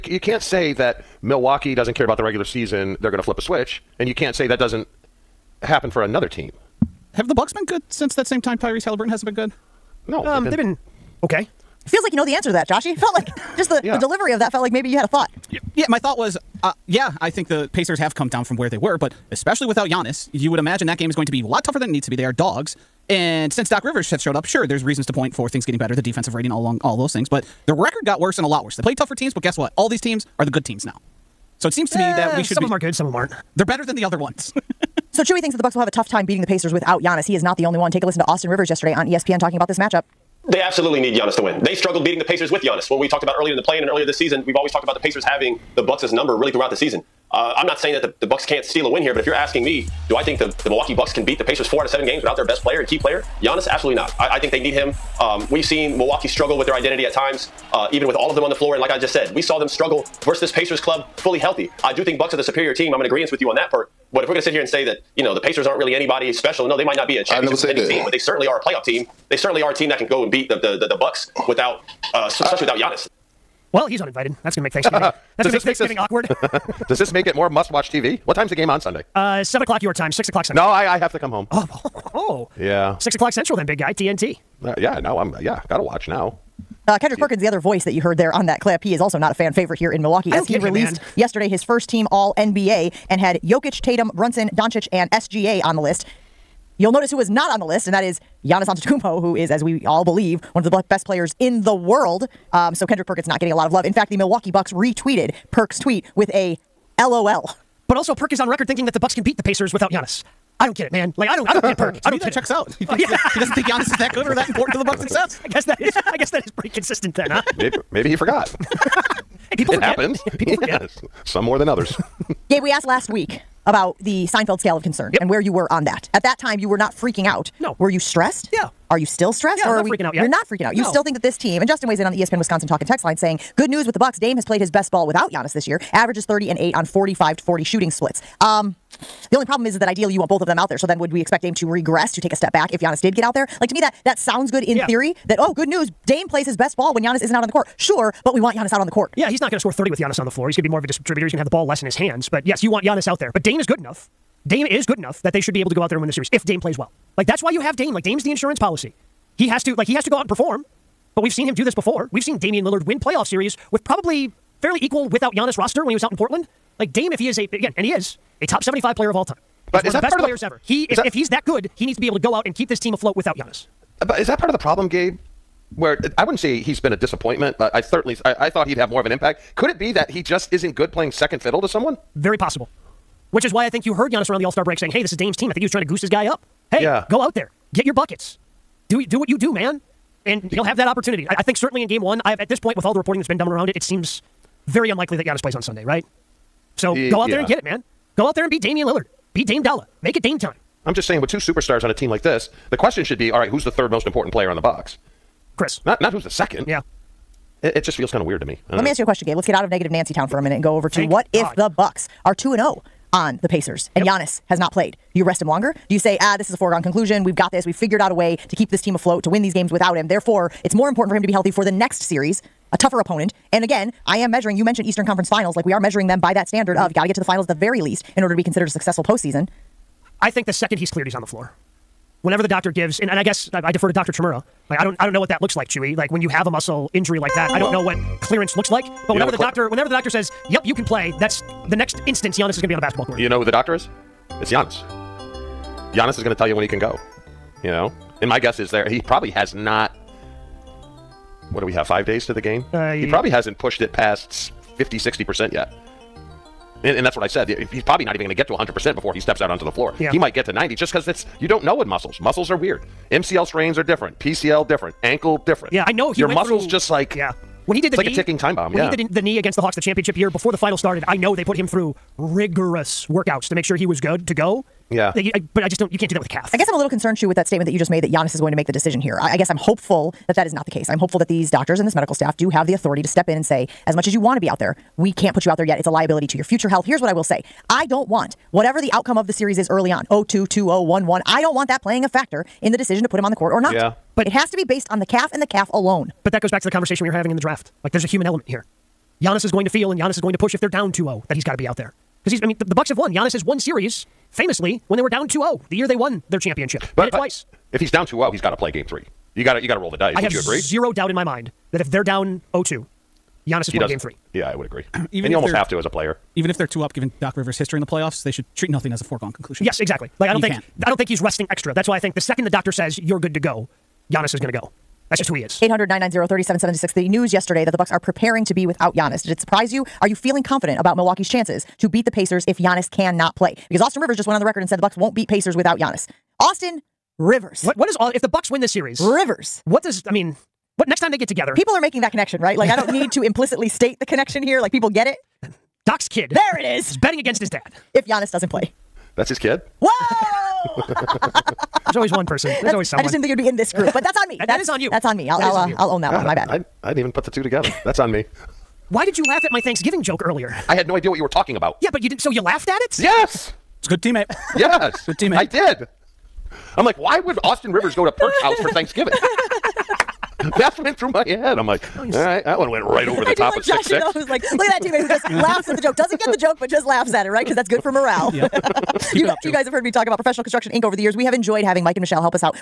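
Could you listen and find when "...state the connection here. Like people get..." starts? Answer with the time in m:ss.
5:43.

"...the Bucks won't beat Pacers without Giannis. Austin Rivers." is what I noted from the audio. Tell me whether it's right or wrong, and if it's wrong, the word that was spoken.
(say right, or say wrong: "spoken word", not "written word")
right.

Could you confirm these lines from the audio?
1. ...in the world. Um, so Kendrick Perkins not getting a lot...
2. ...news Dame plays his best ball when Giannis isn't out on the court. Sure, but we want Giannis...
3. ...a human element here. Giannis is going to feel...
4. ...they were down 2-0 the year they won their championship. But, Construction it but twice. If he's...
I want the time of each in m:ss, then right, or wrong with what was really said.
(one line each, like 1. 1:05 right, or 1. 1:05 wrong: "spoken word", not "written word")
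1. 1:41 right
2. 2:25 right
3. 4:58 right
4. 5:04 wrong: "Did", not "Construction".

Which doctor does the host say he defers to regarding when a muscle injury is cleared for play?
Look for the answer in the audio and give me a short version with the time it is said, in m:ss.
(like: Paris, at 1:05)
Dr. Chmura, at 3:53.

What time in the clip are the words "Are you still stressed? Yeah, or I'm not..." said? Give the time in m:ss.
2:08.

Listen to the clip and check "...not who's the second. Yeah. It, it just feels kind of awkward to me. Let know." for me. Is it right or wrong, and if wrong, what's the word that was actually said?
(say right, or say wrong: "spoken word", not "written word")
wrong: "weird", not "awkward".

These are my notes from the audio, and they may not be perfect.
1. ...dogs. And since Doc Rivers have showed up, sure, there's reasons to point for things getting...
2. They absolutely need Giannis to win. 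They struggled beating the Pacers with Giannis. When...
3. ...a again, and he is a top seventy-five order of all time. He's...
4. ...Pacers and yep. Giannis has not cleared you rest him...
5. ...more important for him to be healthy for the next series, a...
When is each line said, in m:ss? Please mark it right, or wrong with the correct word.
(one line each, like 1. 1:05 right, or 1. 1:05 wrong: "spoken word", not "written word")
1. 0:22 right
2. 0:40 right
3. 2:47 wrong: "player", not "order"
4. 3:33 wrong: "played", not "cleared"
5. 3:40 right.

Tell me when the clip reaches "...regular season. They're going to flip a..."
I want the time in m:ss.
0:02.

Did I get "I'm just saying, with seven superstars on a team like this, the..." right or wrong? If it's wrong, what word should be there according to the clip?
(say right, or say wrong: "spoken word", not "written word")
wrong: "two", not "seven".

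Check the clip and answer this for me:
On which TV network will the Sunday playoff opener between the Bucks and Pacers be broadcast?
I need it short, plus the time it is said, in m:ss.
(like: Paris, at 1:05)
TNT, at 1:23.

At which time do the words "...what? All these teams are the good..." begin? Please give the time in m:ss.
0:29.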